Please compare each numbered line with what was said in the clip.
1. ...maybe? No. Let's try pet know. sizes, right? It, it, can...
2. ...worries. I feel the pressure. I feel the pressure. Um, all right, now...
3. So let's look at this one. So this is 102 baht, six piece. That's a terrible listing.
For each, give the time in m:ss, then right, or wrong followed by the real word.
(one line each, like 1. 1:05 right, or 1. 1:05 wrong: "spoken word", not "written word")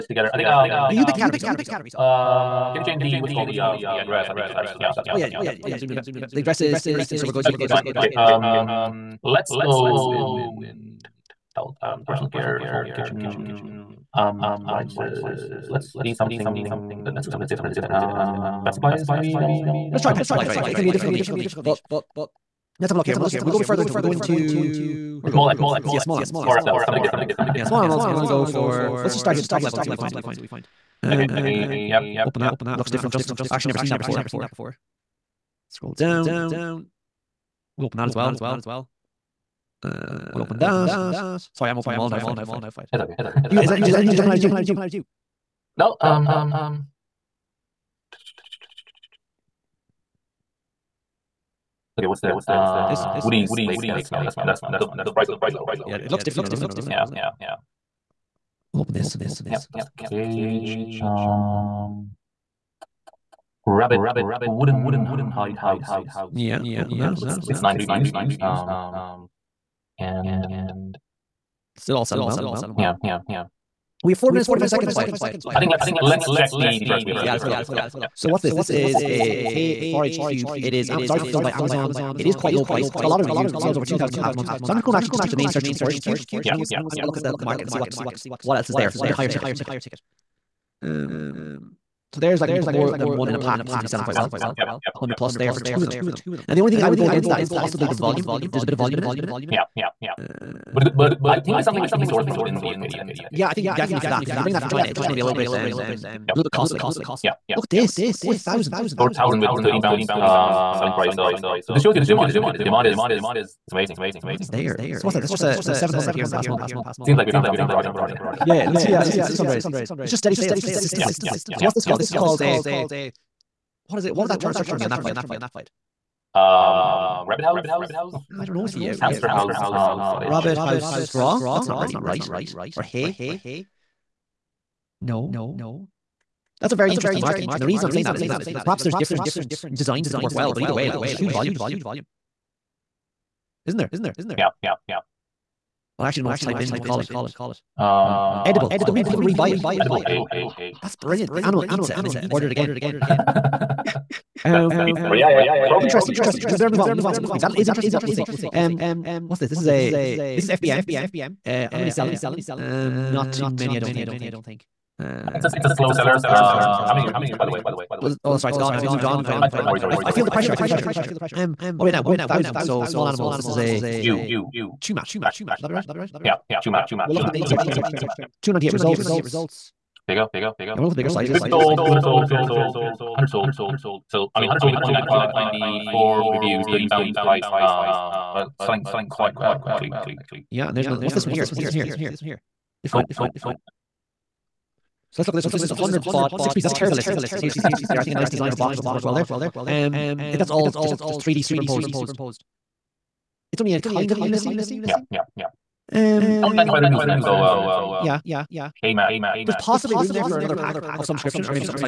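1. 0:19 wrong: "supplies", not "sizes"
2. 2:49 right
3. 3:15 wrong: "100", not "102".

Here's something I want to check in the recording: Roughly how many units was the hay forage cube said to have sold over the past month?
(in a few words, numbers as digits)
Over 2,000.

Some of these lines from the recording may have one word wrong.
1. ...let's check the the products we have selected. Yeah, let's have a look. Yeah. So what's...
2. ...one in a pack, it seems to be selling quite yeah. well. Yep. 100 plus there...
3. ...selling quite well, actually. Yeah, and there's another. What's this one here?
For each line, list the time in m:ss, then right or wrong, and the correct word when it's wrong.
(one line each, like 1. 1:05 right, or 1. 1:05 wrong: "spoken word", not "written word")
1. 1:16 right
2. 1:33 right
3. 3:08 right.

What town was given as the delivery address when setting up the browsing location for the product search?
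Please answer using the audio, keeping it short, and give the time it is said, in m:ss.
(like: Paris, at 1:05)
Innerleithen, at 0:06.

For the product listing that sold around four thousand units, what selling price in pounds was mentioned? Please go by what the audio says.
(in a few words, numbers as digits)
13 pounds.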